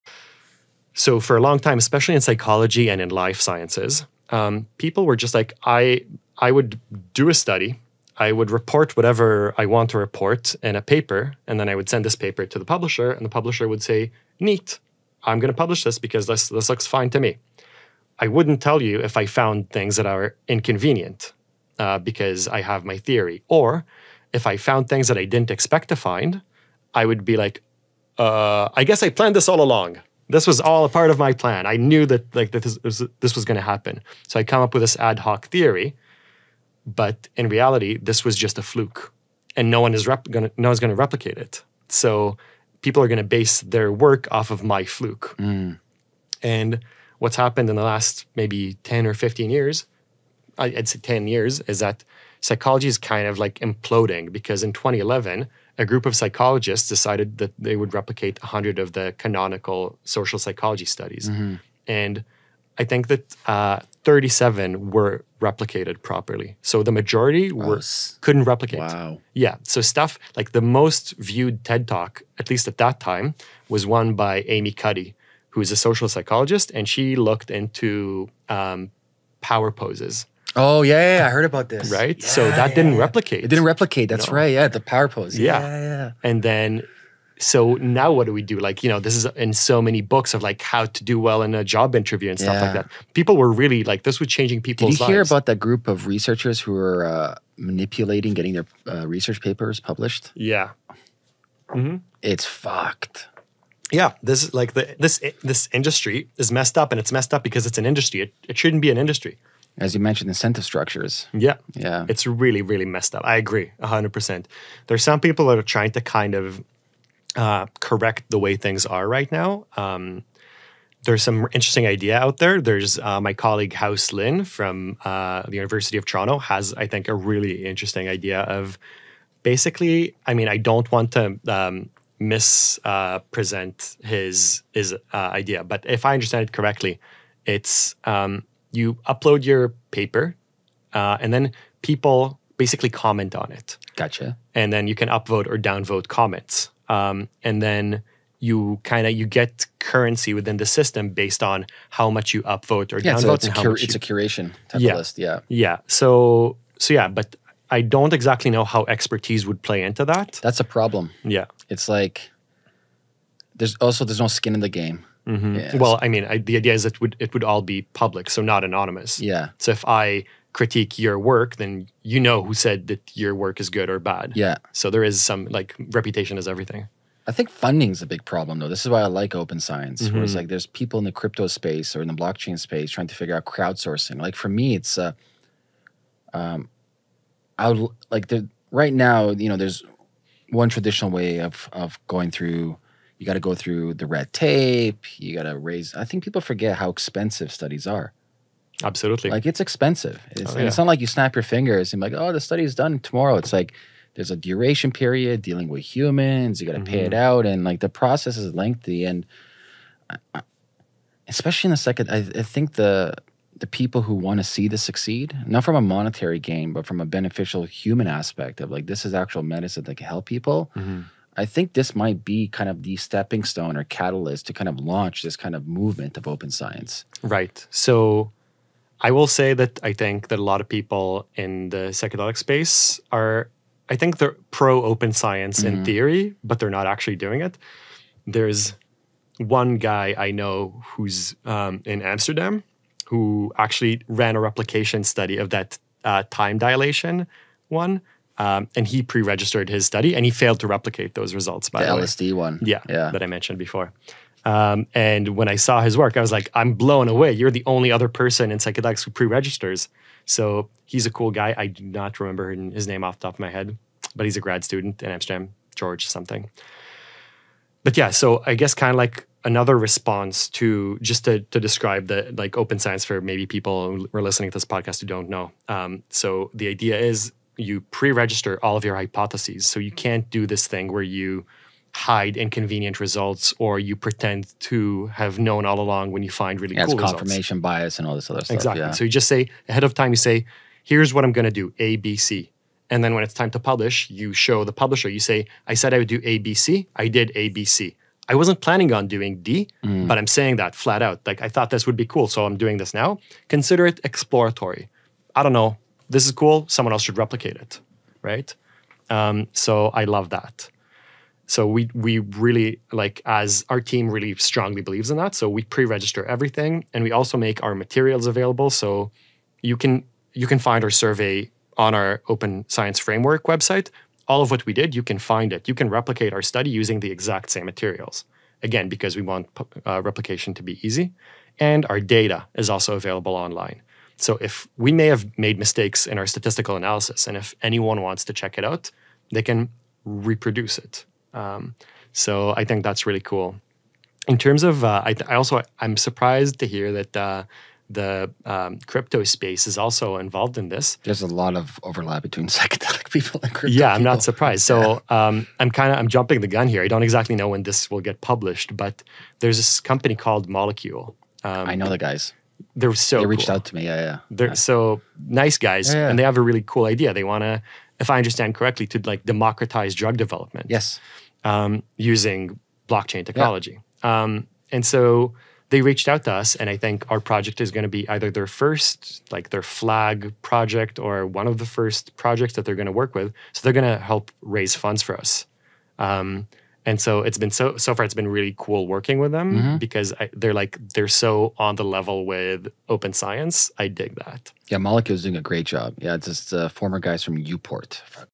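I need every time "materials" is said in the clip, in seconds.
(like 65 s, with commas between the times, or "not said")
317 s, 327 s.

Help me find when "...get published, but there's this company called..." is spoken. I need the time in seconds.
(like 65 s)
358 s.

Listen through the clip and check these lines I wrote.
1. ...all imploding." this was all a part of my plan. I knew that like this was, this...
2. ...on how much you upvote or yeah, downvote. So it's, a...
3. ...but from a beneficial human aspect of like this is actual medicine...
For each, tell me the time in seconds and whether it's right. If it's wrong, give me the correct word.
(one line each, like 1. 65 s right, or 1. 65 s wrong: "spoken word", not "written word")
1. 29 s wrong: "along", not "imploding"
2. 151 s right
3. 216 s right.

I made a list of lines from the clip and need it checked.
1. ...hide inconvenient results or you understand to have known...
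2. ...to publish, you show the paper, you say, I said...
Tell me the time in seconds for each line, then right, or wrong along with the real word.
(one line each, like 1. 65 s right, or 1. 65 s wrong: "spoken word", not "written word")
1. 281 s wrong: "pretend", not "understand"
2. 293 s wrong: "publisher", not "paper".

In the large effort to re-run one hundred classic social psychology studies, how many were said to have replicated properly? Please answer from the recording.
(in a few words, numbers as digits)
37.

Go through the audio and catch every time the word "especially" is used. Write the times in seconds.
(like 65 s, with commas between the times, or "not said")
1 s, 211 s.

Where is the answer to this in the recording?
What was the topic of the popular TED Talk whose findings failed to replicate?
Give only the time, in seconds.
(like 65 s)
79 s.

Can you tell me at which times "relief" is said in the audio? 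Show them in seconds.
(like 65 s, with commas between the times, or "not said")
not said.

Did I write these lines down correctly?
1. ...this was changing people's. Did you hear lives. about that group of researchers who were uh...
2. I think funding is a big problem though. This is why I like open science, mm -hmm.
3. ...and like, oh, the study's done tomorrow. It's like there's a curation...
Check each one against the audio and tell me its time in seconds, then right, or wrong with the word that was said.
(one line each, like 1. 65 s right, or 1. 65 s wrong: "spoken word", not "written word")
1. 94 s right
2. 177 s right
3. 201 s wrong: "duration", not "curation".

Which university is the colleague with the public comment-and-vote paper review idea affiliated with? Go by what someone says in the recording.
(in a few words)
University of Toronto.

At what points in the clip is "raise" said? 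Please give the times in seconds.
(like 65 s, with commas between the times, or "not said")
195 s, 384 s.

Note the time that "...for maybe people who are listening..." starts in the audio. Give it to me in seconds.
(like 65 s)
273 s.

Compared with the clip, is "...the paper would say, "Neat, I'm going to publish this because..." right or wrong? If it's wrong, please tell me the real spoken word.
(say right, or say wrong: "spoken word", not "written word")
wrong: "publisher", not "paper".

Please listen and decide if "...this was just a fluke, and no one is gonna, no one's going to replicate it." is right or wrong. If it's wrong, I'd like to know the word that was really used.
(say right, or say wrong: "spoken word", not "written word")
right.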